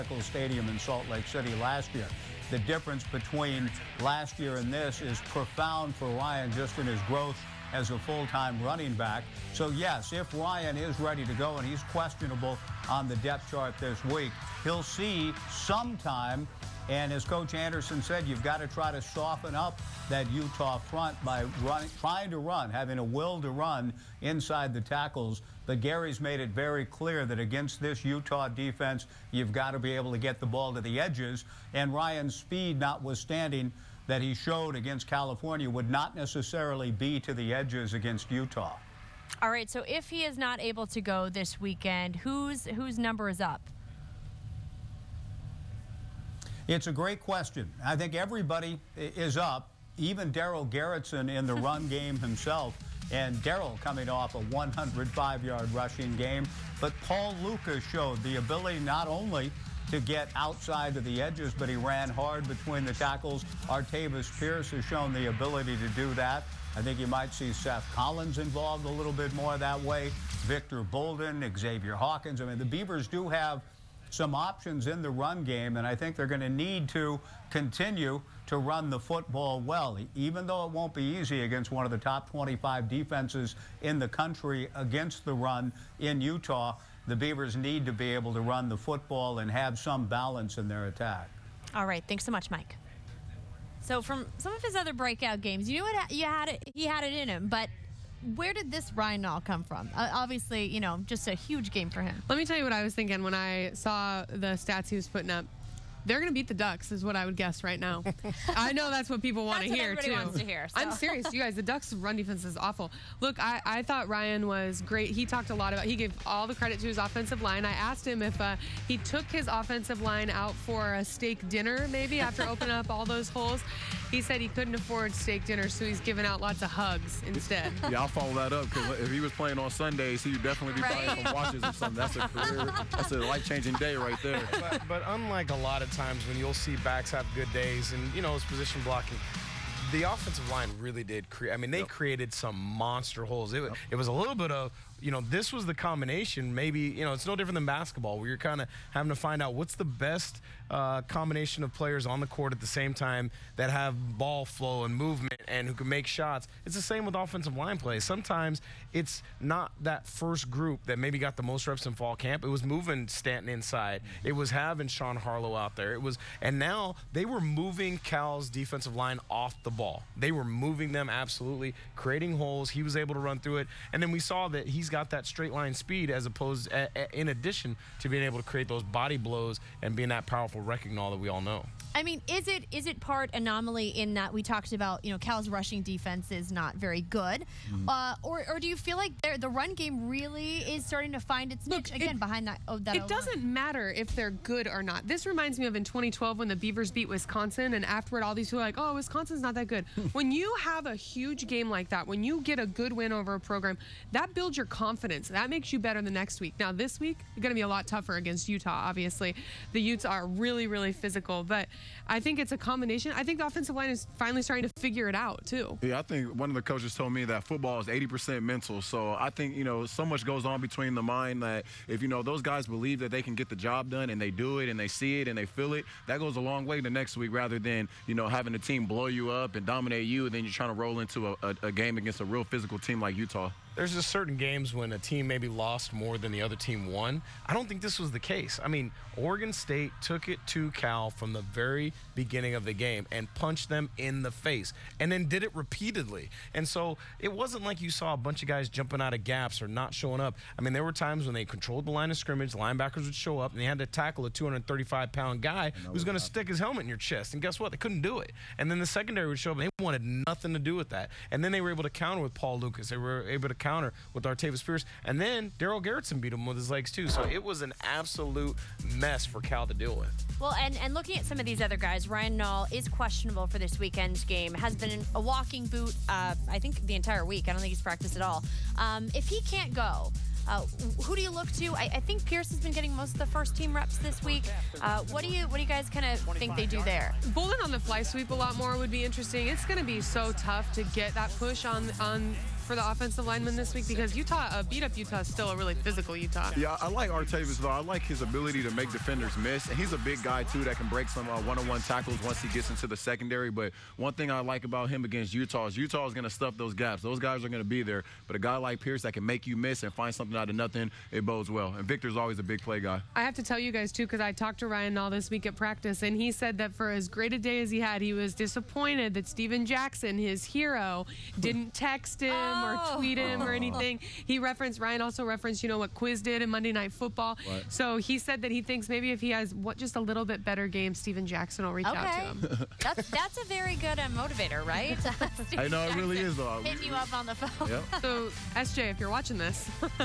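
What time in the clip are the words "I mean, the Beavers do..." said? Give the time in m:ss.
1:12.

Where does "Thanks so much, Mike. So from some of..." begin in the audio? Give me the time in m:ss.
1:32.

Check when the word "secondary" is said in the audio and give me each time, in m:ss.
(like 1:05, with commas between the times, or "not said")
4:18, 5:02.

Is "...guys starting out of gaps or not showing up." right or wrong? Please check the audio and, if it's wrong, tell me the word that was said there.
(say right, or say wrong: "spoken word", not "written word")
wrong: "jumping", not "starting".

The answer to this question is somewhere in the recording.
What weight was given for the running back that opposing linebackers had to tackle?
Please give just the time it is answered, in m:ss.
4:14.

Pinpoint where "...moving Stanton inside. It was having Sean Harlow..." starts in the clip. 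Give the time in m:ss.
2:42.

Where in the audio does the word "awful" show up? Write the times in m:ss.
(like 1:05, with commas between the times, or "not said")
1:52.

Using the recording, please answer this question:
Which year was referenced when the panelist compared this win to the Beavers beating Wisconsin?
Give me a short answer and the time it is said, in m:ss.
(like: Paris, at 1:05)
2012, at 3:15.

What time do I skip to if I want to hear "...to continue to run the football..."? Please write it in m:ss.
1:16.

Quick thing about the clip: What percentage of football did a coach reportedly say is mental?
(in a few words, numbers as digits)
80%.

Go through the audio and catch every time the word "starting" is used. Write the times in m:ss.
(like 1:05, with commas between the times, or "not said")
3:10, 3:34.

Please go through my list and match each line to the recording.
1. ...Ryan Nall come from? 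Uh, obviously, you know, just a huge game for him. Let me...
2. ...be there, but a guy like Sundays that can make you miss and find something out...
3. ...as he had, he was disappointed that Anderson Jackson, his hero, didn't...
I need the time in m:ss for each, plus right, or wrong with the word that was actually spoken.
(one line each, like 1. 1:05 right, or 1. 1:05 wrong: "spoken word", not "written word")
1. 1:38 right
2. 5:07 wrong: "Pierce", not "Sundays"
3. 5:17 wrong: "Steven", not "Anderson".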